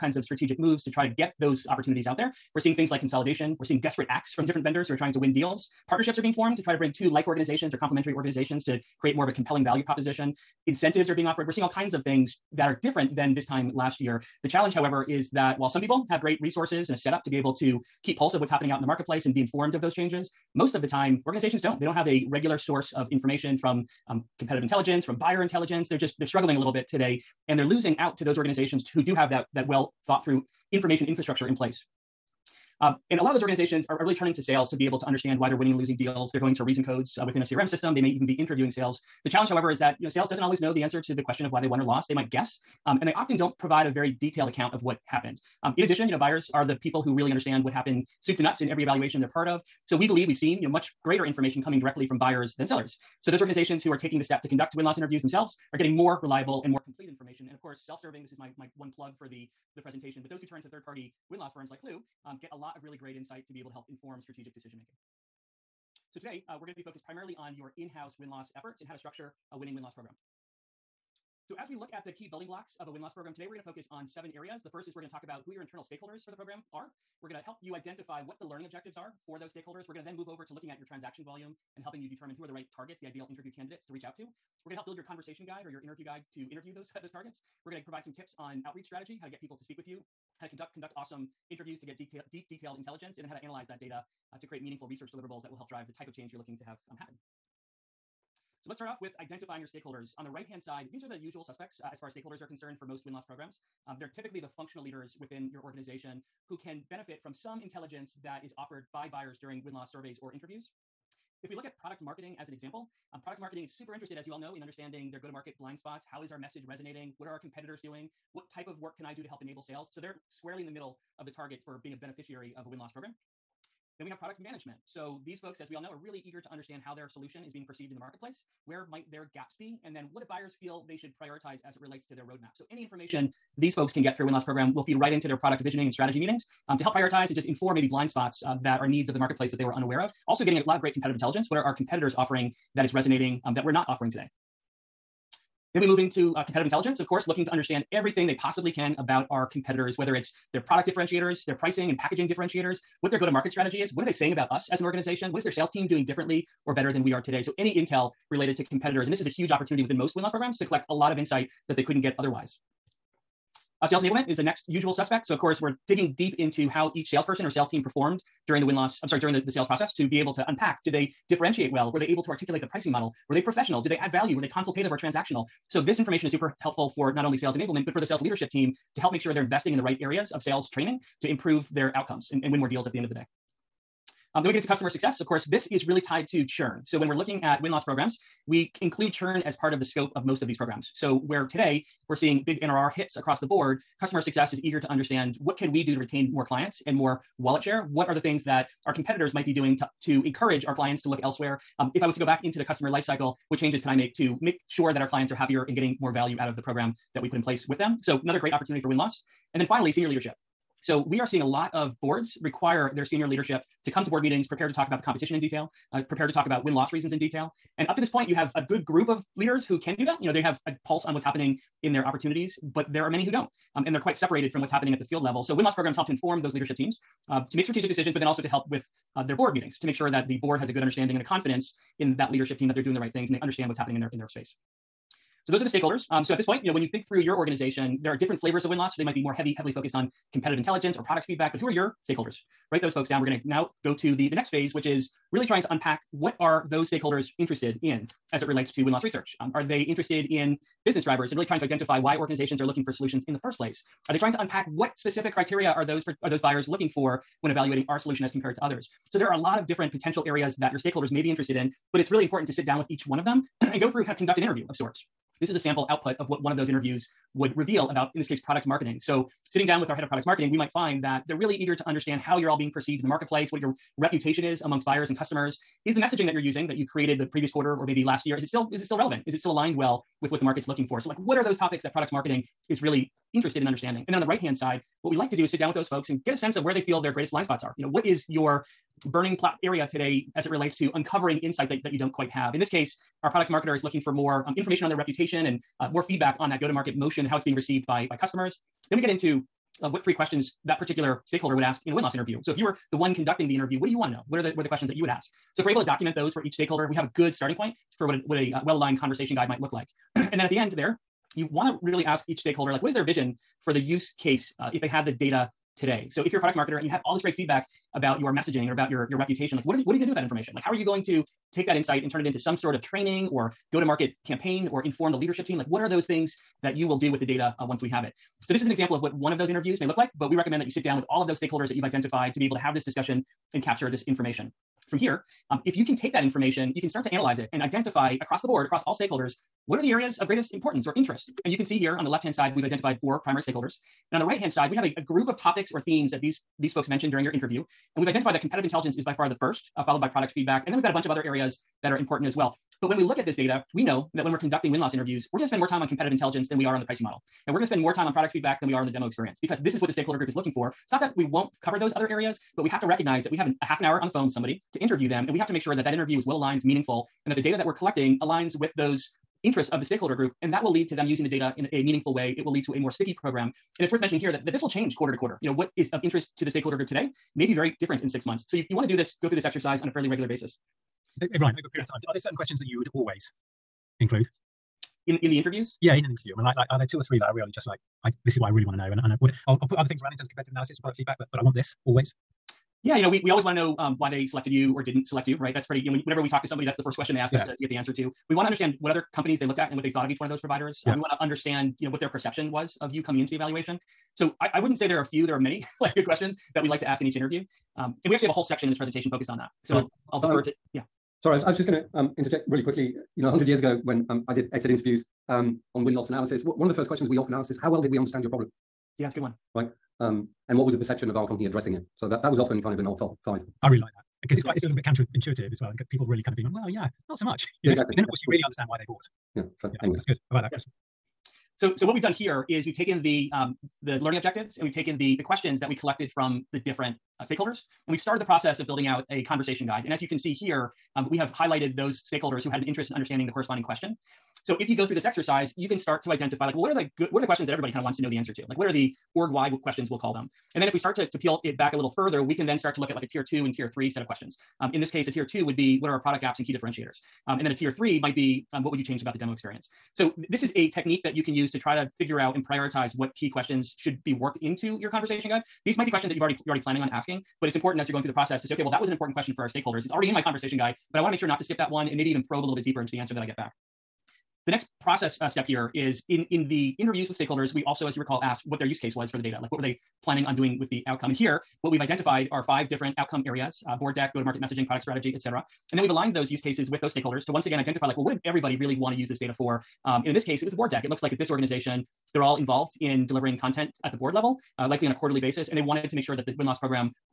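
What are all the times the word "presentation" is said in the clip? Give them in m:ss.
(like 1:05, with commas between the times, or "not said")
0:59, 6:48.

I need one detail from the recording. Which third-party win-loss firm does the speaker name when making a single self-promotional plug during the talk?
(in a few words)
Klue.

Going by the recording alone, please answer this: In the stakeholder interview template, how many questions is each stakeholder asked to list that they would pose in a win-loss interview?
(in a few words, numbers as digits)
3.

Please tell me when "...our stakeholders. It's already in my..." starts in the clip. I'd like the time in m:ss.
7:49.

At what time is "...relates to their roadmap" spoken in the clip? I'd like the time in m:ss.
2:11.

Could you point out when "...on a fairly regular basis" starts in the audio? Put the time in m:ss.
6:19.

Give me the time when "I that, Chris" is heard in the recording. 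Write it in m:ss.
7:10.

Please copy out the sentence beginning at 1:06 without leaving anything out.
So today uh, we're going to be focused primarily on your in-house win-loss efforts and how to structure a winning win-loss program.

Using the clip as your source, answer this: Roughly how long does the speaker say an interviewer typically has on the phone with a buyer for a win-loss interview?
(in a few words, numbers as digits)
Half an hour.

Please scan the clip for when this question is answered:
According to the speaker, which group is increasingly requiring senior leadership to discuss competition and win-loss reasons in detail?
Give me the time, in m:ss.
3:32.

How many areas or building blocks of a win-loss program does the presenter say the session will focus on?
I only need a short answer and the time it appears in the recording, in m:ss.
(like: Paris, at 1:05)
7, at 1:14.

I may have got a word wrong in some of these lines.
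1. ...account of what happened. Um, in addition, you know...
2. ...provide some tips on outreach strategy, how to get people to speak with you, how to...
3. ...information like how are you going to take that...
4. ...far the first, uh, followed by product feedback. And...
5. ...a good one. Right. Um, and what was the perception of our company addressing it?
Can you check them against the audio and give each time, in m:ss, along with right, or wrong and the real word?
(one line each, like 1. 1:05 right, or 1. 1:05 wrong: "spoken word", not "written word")
1. 0:44 right
2. 1:27 right
3. 5:20 right
4. 5:49 right
5. 6:59 right.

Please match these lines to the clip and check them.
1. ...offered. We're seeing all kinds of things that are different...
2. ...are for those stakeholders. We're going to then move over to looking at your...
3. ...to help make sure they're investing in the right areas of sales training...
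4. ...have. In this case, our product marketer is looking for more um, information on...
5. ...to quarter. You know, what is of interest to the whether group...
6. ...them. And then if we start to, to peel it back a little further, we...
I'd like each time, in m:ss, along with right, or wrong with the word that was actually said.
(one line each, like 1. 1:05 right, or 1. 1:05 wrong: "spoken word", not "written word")
1. 0:11 right
2. 1:18 right
3. 2:58 right
4. 4:52 right
5. 6:15 wrong: "stakeholder", not "whether"
6. 7:30 right.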